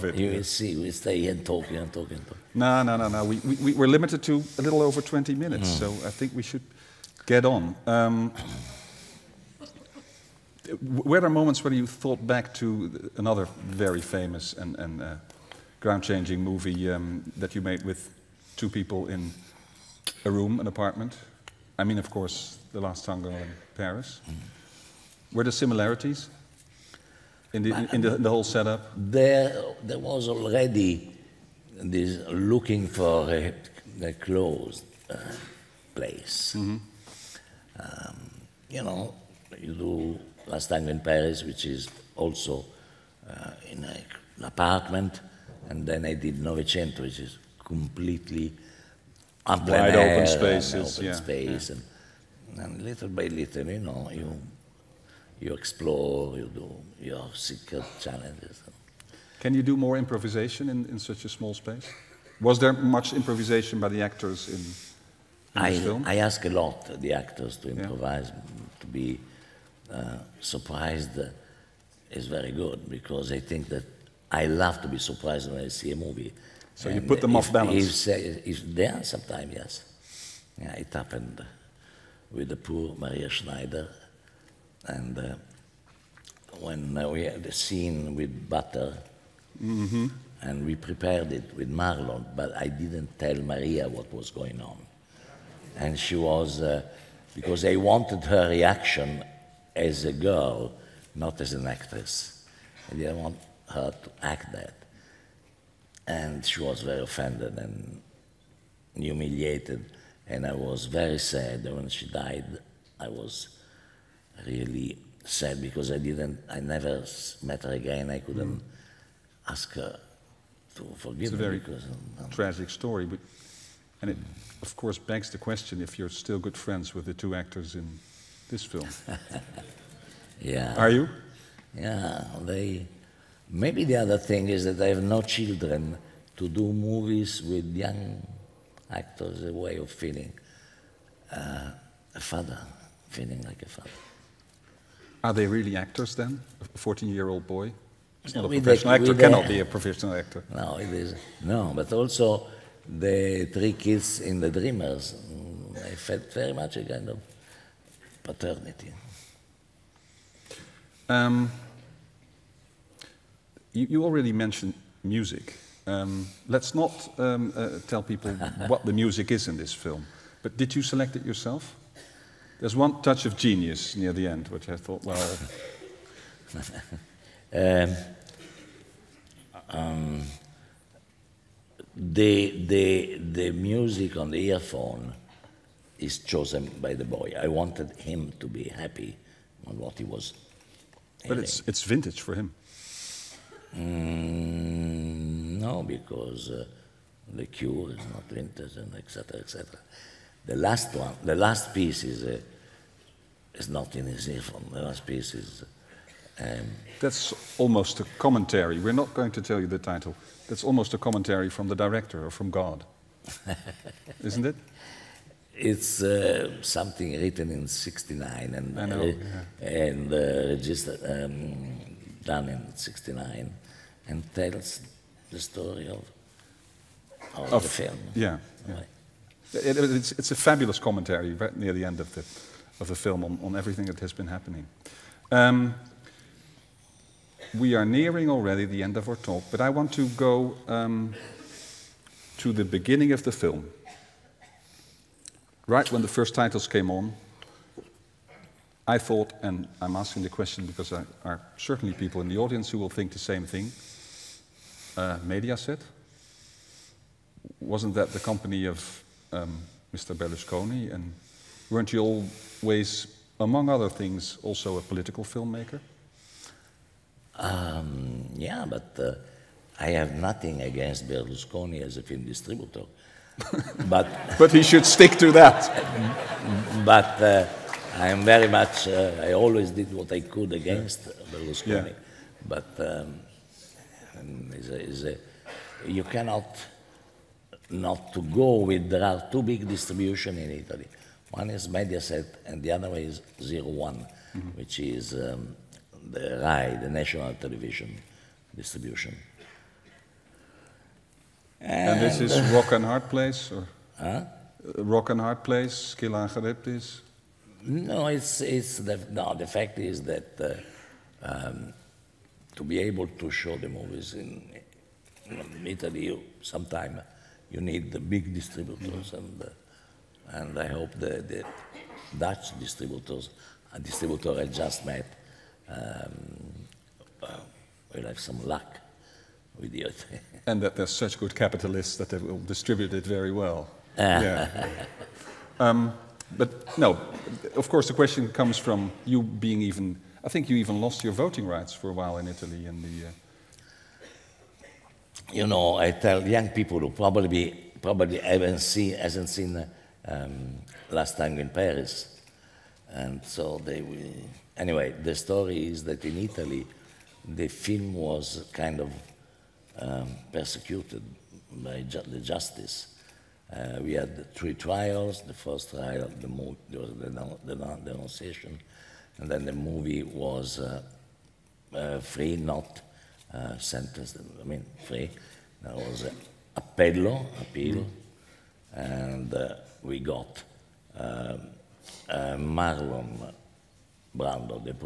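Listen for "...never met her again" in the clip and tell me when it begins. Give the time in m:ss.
1:56.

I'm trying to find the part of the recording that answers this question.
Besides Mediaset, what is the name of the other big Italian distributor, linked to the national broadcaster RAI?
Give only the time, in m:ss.
4:53.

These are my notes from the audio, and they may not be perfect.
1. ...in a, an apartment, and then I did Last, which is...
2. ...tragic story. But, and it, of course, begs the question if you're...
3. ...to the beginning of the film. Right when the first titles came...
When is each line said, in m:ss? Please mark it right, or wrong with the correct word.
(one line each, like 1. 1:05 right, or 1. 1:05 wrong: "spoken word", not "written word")
1. 0:43 wrong: "Novecento", not "Last"
2. 2:02 right
3. 4:02 right.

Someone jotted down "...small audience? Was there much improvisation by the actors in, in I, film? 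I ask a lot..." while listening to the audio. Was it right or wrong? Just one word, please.
wrong.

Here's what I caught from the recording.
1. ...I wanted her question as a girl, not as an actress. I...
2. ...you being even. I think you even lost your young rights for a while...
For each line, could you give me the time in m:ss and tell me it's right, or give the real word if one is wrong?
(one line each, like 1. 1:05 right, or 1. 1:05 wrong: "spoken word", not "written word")
1. 1:37 wrong: "reaction", not "question"
2. 5:39 wrong: "voting", not "young".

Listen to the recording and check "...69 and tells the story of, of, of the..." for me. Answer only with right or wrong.
right.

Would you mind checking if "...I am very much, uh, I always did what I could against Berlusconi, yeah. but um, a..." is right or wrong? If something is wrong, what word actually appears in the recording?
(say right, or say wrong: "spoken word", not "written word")
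right.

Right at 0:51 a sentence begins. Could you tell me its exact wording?
And, and little by little, you know, you you explore, you do, your secret challenges.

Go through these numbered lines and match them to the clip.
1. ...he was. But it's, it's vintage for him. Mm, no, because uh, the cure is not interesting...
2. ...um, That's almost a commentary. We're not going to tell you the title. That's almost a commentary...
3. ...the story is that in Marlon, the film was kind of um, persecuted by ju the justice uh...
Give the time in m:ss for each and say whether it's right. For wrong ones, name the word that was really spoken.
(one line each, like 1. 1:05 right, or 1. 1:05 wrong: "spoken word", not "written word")
1. 3:09 right
2. 3:26 right
3. 5:55 wrong: "Italy", not "Marlon".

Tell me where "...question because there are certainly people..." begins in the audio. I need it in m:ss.
4:10.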